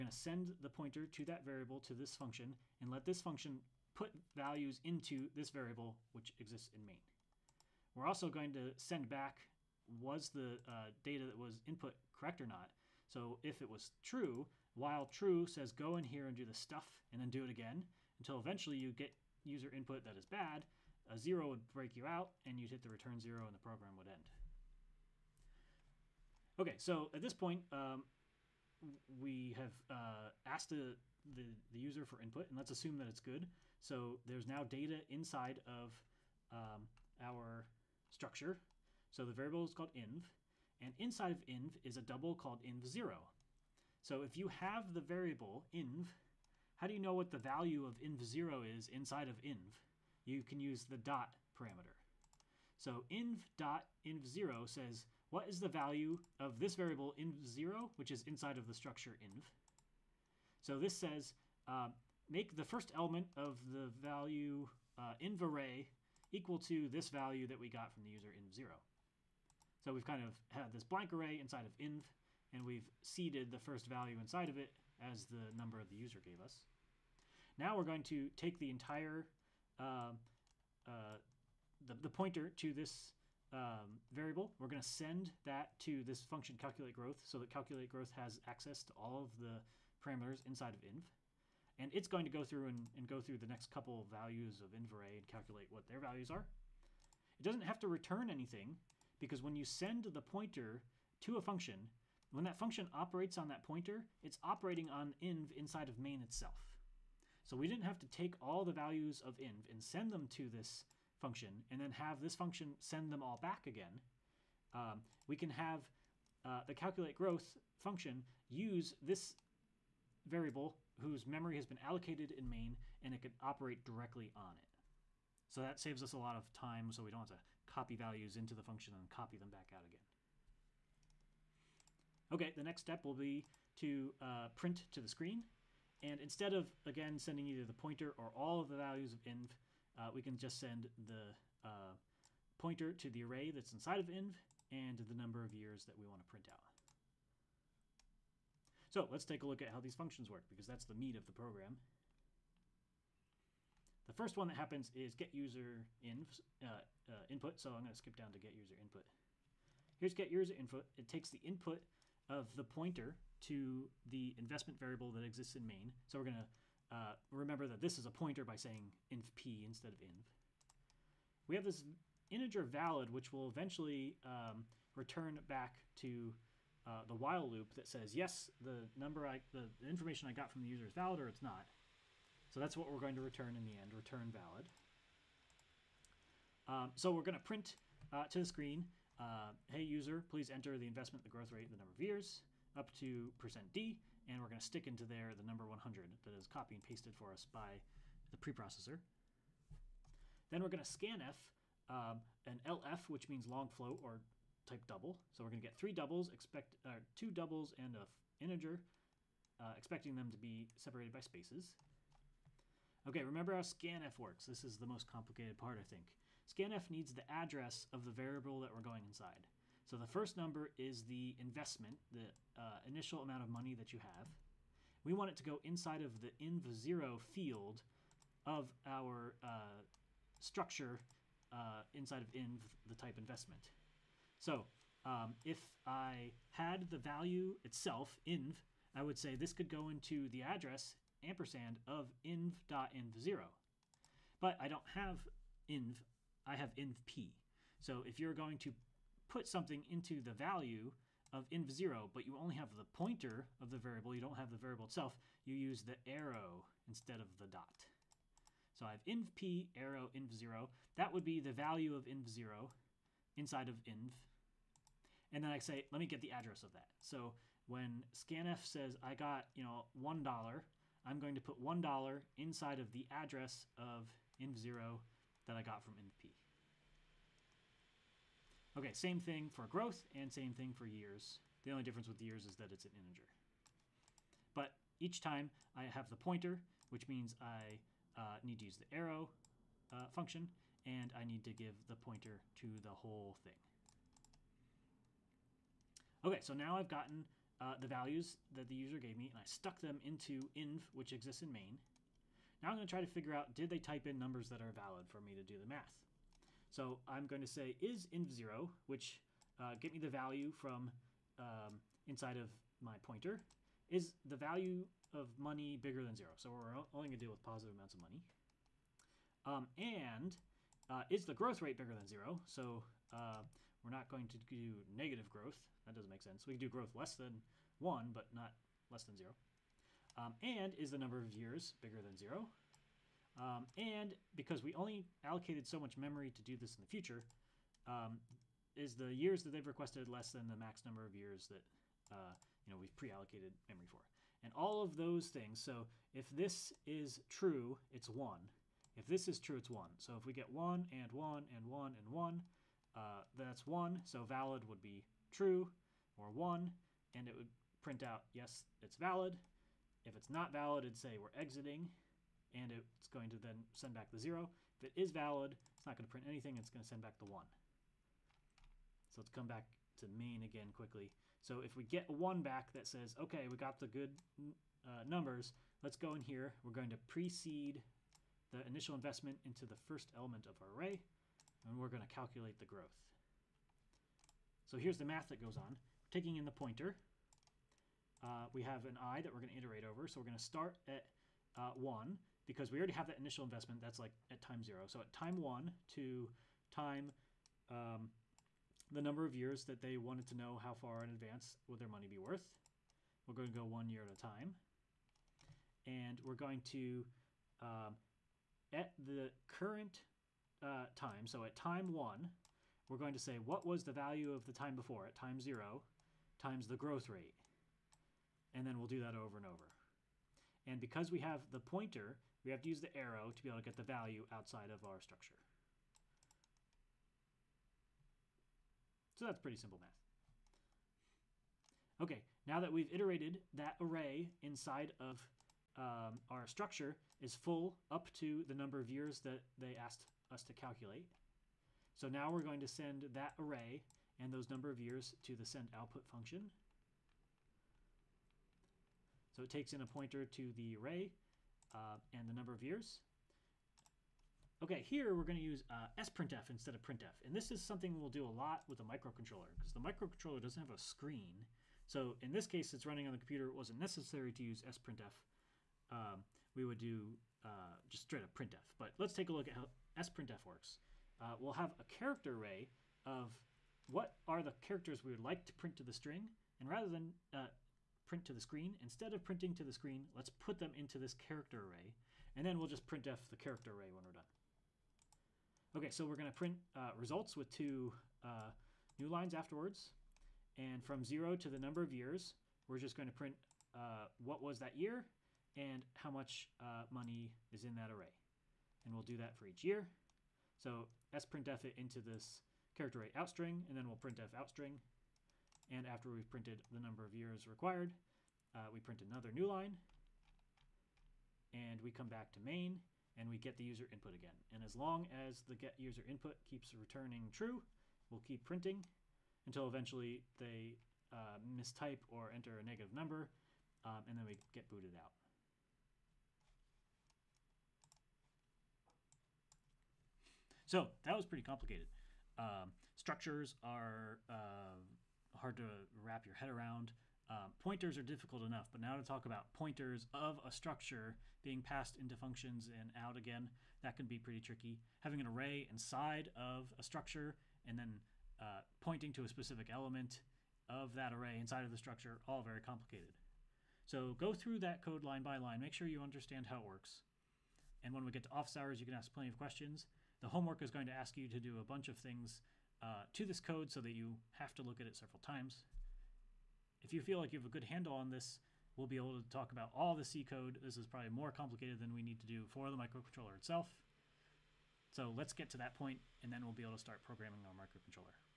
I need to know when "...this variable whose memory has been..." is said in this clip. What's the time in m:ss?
1:59.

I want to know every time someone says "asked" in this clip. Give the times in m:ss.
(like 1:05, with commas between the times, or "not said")
0:30, 7:19.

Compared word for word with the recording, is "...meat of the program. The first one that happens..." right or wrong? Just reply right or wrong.
right.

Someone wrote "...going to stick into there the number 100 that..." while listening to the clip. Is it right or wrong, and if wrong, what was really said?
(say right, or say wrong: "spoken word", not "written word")
right.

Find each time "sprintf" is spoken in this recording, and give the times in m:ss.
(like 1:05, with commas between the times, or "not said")
7:36, 7:44, 7:50, 8:21.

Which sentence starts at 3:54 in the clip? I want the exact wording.
So um, if I had the value itself, inv, I would say this could go into the address ampersand of inv.inv0.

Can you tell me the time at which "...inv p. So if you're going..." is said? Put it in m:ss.
4:06.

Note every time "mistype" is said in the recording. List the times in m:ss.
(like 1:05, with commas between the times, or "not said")
8:41.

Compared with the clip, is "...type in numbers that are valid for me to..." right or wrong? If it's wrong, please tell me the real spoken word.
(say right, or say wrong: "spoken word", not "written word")
right.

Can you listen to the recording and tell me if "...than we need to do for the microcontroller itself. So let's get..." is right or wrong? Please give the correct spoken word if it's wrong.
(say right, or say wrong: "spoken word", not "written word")
right.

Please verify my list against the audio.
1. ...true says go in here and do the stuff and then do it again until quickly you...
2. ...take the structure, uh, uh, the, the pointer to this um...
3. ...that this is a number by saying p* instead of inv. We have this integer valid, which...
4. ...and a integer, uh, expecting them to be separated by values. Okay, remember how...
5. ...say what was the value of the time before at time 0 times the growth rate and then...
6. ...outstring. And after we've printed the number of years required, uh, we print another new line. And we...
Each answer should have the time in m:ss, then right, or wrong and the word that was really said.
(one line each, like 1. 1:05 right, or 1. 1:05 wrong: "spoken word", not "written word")
1. 0:15 wrong: "eventually", not "quickly"
2. 1:18 wrong: "entire", not "structure"
3. 2:47 wrong: "pointer", not "number"
4. 3:27 wrong: "spaces", not "values"
5. 6:53 right
6. 8:24 right.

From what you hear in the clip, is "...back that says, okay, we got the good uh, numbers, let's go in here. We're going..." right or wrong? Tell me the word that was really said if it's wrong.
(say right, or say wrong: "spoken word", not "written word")
right.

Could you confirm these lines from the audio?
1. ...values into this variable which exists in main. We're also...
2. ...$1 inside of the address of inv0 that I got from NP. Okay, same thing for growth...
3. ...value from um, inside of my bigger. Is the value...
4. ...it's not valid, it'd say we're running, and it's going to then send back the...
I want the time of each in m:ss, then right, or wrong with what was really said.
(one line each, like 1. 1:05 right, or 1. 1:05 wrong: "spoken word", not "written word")
1. 0:04 right
2. 4:31 right
3. 5:10 wrong: "pointer", not "bigger"
4. 6:00 wrong: "exiting", not "running".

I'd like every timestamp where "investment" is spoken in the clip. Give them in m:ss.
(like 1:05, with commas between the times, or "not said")
2:44, 3:10, 3:41, 3:53, 6:18, 6:33.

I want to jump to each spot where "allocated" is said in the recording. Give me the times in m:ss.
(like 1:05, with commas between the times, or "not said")
2:01, 5:35, 5:42.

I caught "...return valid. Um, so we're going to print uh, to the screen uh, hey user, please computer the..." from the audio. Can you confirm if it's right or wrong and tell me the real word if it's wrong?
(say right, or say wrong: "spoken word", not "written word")
wrong: "enter", not "computer".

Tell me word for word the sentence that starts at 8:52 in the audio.
Um, structures are uh, hard to wrap your head around.